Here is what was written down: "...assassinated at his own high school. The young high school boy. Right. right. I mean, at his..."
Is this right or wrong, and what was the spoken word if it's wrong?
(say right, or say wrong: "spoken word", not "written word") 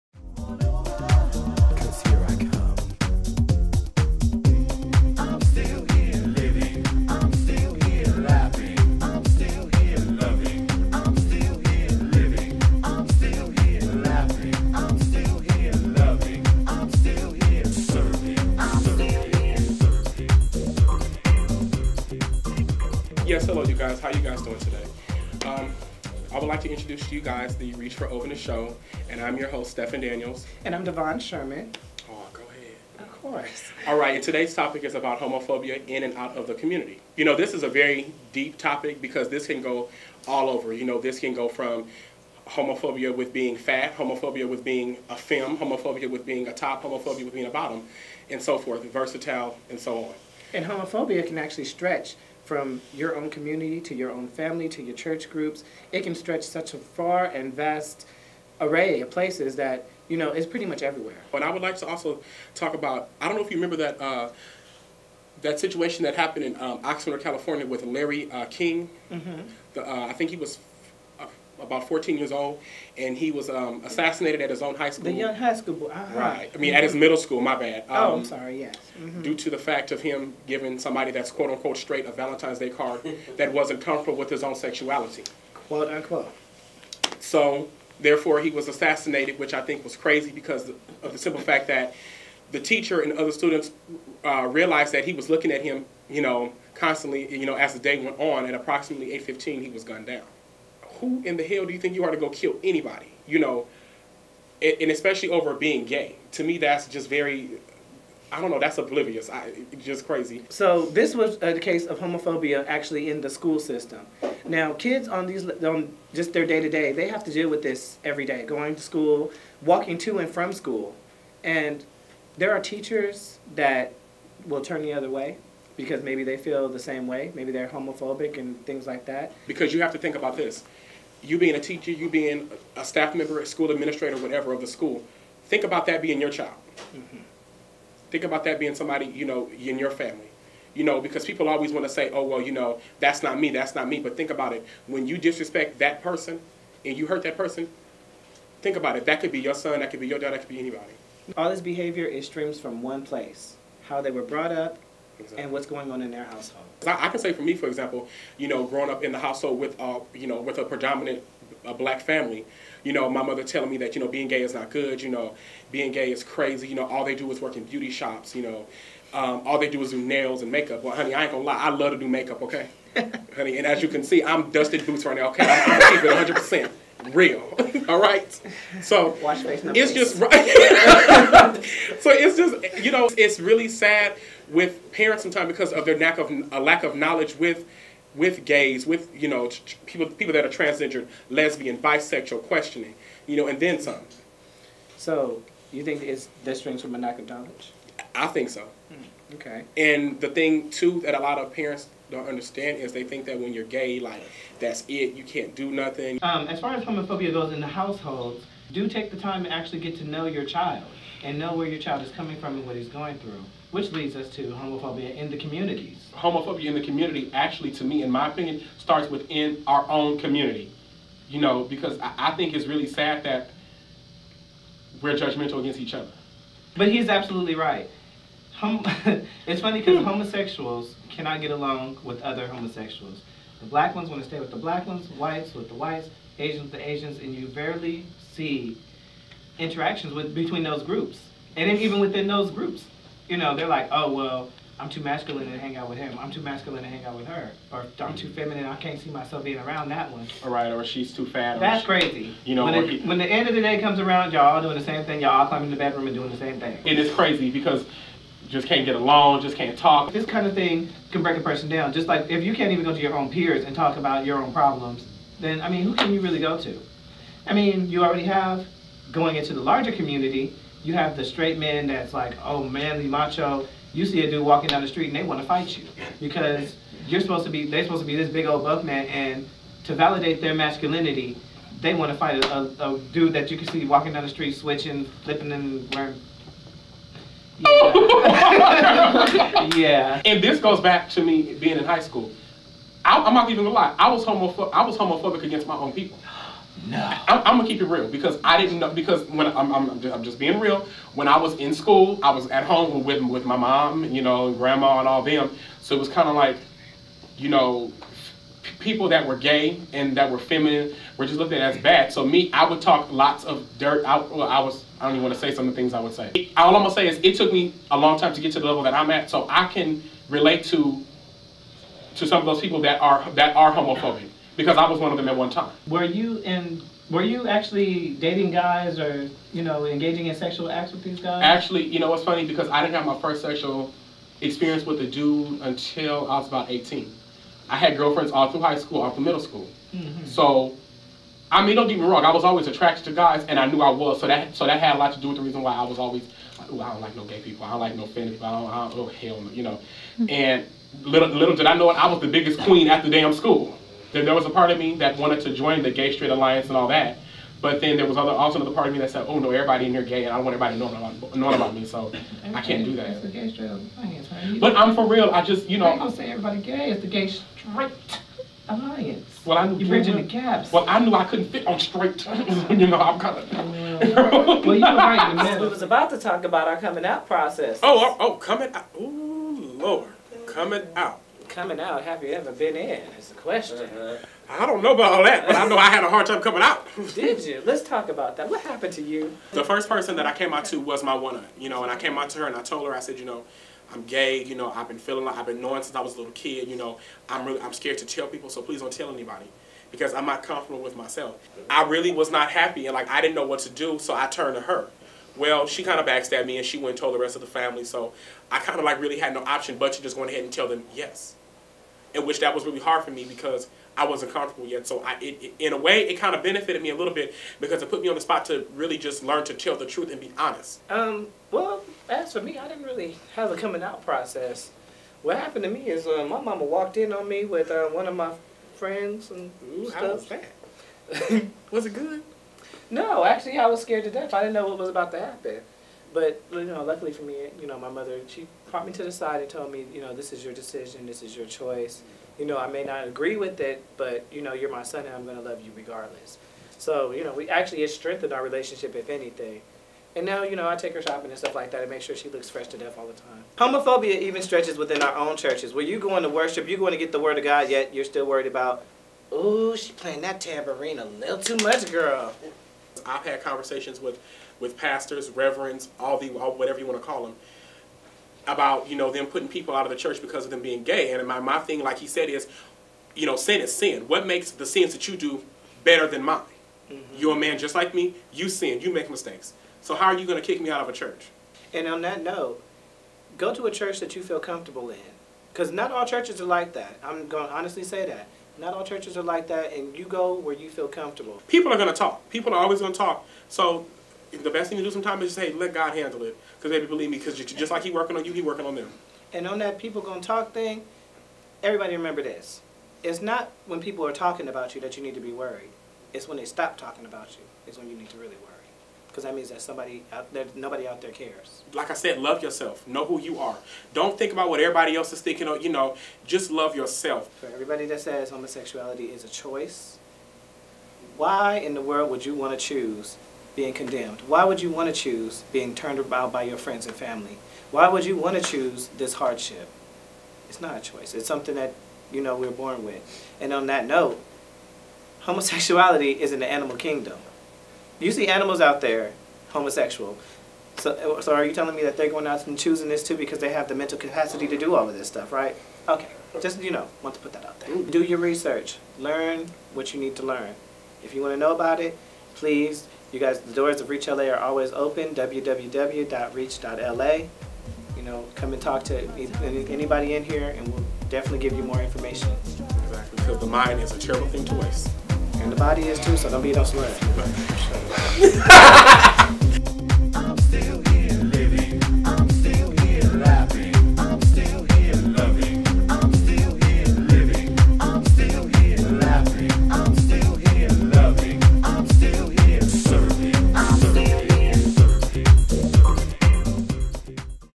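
right.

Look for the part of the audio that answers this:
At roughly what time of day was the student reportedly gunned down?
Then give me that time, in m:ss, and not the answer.
1:39.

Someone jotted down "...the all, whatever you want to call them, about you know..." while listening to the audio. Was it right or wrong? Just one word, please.
right.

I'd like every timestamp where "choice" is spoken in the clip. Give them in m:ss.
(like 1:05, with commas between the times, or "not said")
7:21, 8:39, 8:50.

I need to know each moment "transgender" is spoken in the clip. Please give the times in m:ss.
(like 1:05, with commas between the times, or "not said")
3:10.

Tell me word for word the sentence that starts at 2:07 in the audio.
Maybe they're homophobic and things like that.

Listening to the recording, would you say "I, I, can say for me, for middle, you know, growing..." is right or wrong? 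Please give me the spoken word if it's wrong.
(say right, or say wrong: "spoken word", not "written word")
wrong: "example", not "middle".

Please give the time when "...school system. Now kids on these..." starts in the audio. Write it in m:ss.
1:53.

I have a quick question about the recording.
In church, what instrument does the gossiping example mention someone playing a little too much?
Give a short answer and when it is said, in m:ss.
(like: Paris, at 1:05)
tambourine, at 7:40.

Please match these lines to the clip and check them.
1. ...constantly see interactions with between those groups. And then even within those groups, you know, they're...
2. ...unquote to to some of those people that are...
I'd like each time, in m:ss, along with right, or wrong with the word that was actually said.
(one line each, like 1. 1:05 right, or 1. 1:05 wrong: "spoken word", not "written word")
1. 3:57 wrong: "rarely", not "constantly"
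2. 5:20 wrong: "relate", not "unquote".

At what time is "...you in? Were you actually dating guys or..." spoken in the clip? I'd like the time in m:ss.
5:26.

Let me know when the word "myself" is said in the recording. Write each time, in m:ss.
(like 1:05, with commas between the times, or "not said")
4:09, 6:40.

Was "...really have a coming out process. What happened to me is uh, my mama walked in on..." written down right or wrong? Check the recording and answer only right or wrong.
right.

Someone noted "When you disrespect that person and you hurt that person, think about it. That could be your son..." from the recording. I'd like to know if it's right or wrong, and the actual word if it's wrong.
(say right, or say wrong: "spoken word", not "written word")
right.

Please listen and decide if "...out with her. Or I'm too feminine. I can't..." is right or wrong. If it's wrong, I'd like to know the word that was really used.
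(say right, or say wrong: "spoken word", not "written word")
right.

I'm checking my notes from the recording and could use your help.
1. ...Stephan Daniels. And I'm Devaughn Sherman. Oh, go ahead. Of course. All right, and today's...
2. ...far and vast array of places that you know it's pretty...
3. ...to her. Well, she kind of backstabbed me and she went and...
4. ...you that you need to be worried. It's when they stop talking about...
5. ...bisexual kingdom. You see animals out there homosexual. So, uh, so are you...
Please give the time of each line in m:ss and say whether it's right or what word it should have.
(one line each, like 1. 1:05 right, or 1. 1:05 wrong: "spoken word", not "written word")
1. 0:29 right
2. 0:56 right
3. 6:44 right
4. 8:24 right
5. 8:56 wrong: "animal", not "bisexual".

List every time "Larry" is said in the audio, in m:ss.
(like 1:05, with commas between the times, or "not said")
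1:07.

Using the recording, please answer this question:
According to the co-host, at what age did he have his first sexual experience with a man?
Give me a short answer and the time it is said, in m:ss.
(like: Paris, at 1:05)
18, at 5:36.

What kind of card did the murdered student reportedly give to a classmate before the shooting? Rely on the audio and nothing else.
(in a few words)
Valentine's Day card.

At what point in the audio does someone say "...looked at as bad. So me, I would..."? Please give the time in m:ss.
5:11.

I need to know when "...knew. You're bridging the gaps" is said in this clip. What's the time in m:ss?
6:09.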